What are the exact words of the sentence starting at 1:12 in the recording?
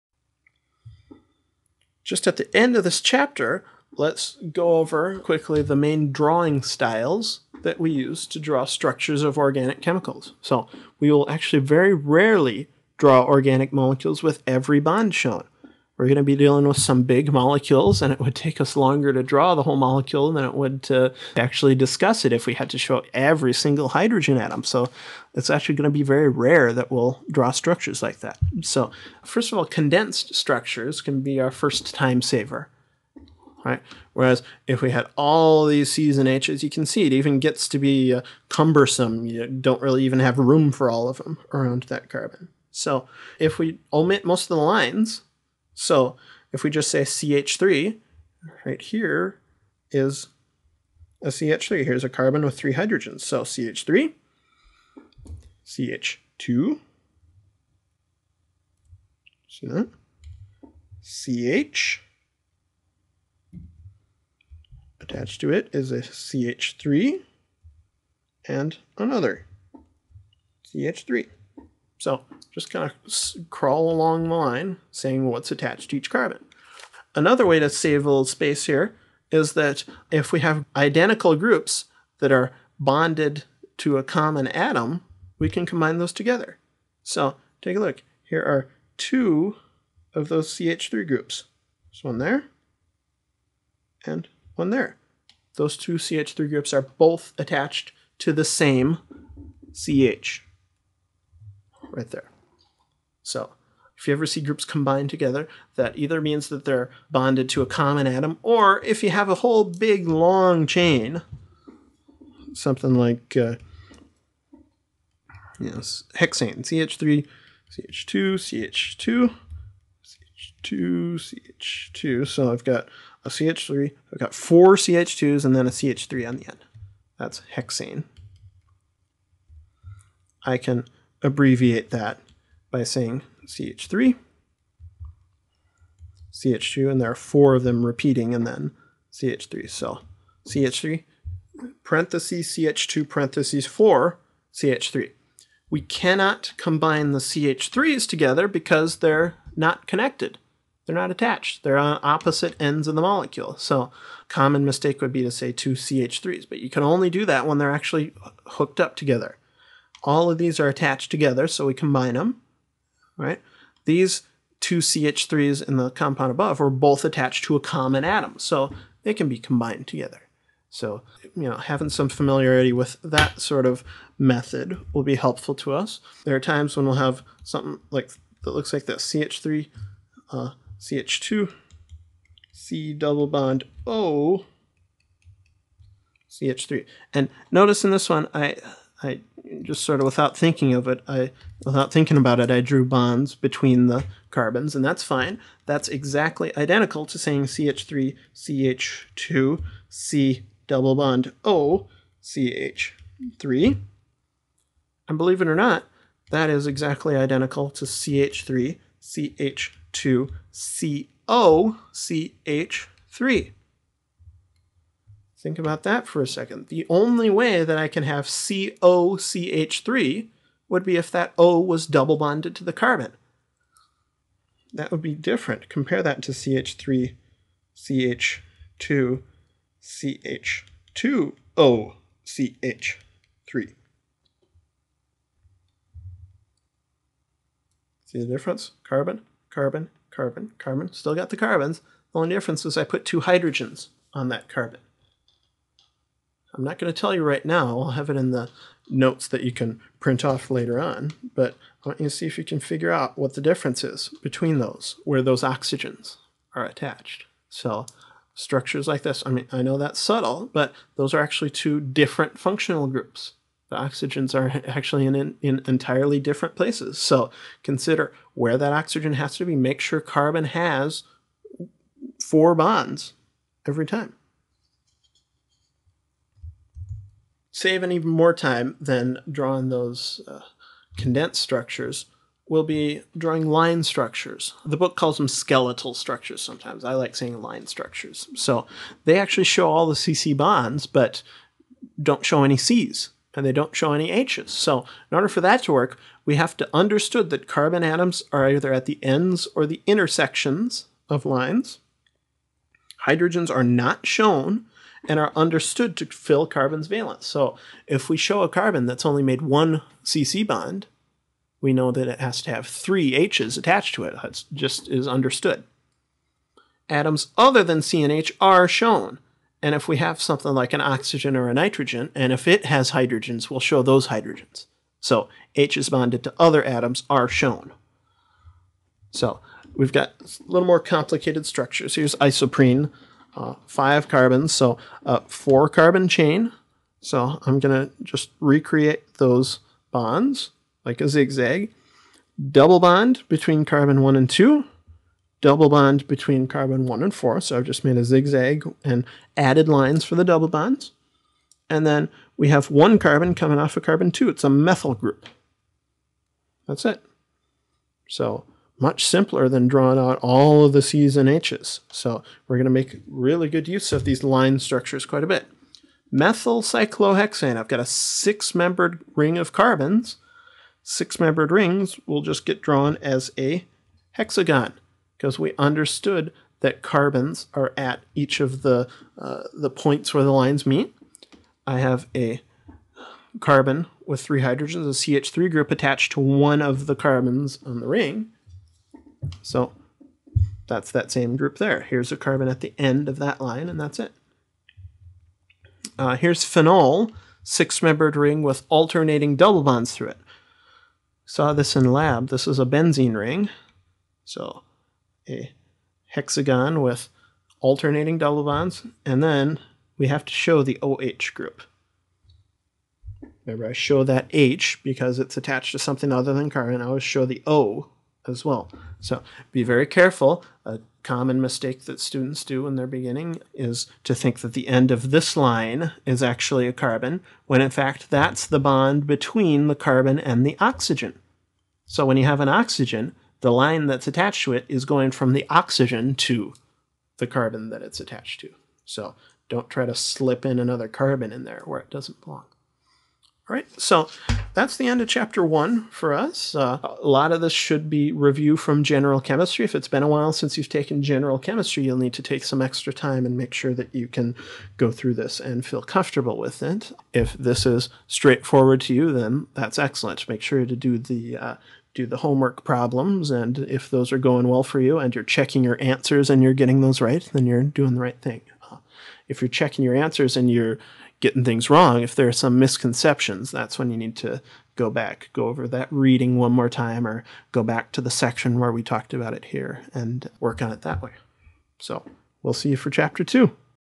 So just kind of crawl along the line, saying what's attached to each carbon.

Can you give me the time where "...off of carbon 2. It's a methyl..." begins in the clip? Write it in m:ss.
5:53.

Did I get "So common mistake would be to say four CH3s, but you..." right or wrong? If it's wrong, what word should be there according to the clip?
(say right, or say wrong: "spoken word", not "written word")
wrong: "two", not "four".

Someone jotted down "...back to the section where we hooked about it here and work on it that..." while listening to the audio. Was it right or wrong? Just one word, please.
wrong.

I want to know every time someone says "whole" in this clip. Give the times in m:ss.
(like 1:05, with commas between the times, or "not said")
0:19, 1:49.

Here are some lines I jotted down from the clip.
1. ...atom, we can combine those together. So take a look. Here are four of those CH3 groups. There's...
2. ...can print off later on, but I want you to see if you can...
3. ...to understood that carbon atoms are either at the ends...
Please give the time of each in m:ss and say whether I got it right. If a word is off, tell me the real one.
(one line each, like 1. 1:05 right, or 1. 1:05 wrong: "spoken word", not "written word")
1. 1:24 wrong: "two", not "four"
2. 4:09 right
3. 4:56 right.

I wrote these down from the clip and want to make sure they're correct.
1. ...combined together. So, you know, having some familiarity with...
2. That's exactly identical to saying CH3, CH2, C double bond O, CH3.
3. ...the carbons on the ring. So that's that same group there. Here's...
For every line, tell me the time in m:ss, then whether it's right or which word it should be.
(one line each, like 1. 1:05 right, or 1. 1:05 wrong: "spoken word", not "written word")
1. 2:49 right
2. 3:15 right
3. 6:26 right.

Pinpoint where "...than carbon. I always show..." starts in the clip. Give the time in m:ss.
6:56.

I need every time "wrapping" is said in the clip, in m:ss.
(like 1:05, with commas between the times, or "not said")
not said.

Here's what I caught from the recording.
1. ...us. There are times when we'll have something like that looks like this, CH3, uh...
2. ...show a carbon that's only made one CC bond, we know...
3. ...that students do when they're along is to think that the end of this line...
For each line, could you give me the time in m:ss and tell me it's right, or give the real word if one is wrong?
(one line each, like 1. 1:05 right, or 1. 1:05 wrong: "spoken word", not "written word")
1. 2:55 right
2. 5:08 right
3. 7:01 wrong: "beginning", not "along".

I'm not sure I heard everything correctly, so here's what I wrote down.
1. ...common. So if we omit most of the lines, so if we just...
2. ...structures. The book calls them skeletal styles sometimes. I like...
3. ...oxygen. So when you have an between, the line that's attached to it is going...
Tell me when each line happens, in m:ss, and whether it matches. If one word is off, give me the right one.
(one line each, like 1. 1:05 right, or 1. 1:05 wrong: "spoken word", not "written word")
1. 0:42 wrong: "carbon", not "common"
2. 4:43 wrong: "structures", not "styles"
3. 7:10 wrong: "oxygen", not "between".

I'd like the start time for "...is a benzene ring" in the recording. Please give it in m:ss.
6:42.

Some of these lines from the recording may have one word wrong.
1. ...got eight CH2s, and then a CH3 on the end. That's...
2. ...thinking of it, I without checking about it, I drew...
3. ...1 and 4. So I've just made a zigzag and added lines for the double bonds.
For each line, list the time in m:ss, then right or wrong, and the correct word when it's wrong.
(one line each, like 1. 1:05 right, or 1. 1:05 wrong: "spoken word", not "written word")
1. 2:04 wrong: "four", not "eight"
2. 3:10 wrong: "thinking", not "checking"
3. 5:46 right.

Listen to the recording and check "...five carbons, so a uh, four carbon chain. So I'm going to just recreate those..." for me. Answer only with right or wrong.
right.